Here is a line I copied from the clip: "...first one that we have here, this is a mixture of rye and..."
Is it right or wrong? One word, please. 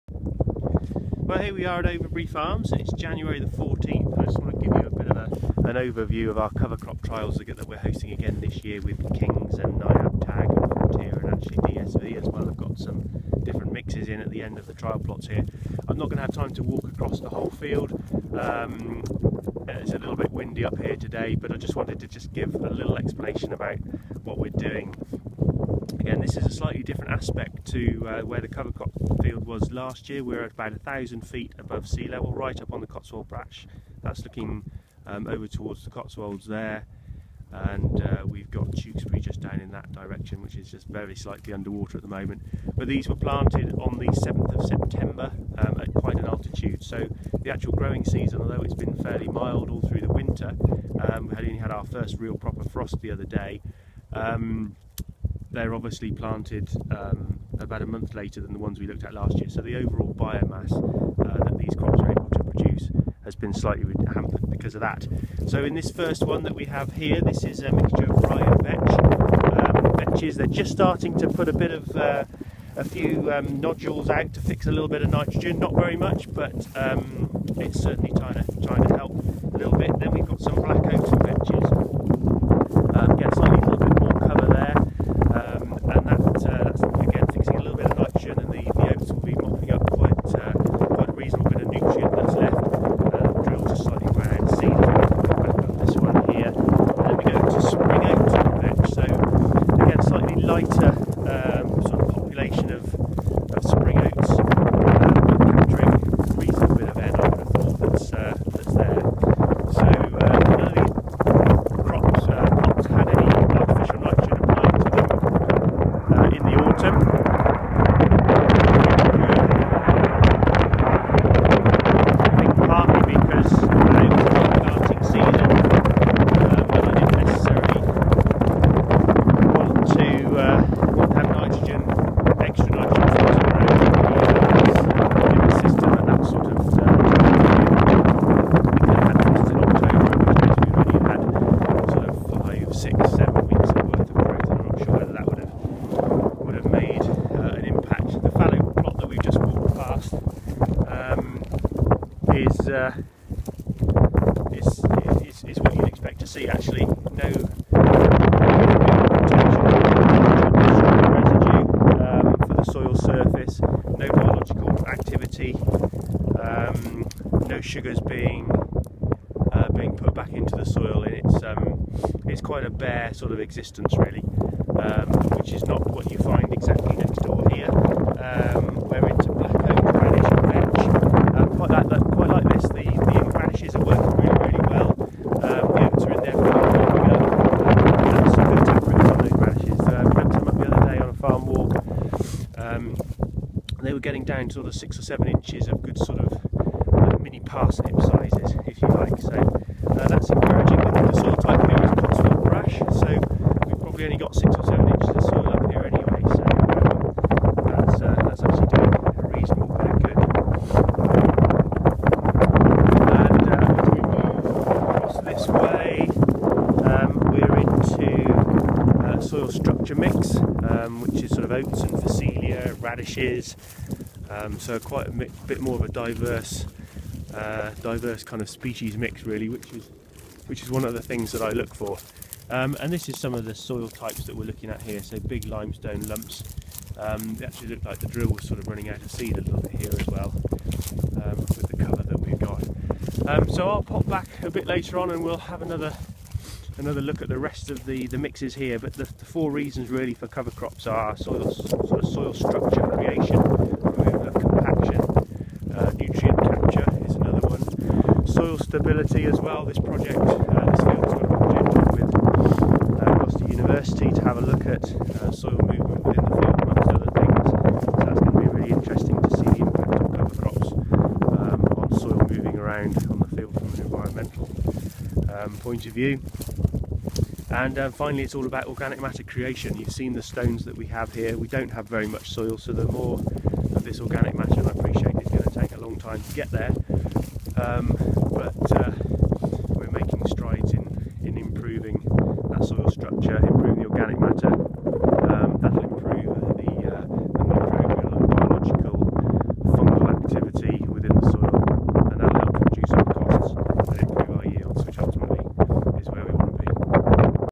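right.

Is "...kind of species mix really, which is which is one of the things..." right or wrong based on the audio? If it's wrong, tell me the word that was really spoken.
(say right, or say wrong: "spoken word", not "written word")
right.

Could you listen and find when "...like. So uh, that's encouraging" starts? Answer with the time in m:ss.
3:18.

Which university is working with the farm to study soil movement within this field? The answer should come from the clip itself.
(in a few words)
Gloucester University.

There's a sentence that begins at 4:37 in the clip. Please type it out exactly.
And um, finally, it's all about organic matter creation.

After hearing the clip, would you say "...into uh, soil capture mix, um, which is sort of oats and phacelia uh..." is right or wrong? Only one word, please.
wrong.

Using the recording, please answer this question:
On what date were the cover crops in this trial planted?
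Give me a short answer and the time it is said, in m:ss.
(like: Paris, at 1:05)
7th of September, at 0:44.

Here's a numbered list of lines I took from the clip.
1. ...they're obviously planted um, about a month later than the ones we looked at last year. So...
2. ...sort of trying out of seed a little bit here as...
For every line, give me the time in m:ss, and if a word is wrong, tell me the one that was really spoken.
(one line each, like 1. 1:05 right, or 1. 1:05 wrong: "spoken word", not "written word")
1. 0:55 right
2. 3:58 wrong: "running", not "trying".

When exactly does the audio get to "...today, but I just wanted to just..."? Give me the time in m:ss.
0:20.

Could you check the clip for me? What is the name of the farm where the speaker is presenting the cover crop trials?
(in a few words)
Overbury Farms.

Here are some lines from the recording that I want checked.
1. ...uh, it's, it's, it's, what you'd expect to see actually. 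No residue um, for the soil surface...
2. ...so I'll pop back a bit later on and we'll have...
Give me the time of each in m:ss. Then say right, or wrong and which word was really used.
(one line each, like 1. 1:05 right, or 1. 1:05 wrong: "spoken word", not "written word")
1. 2:32 right
2. 4:03 right.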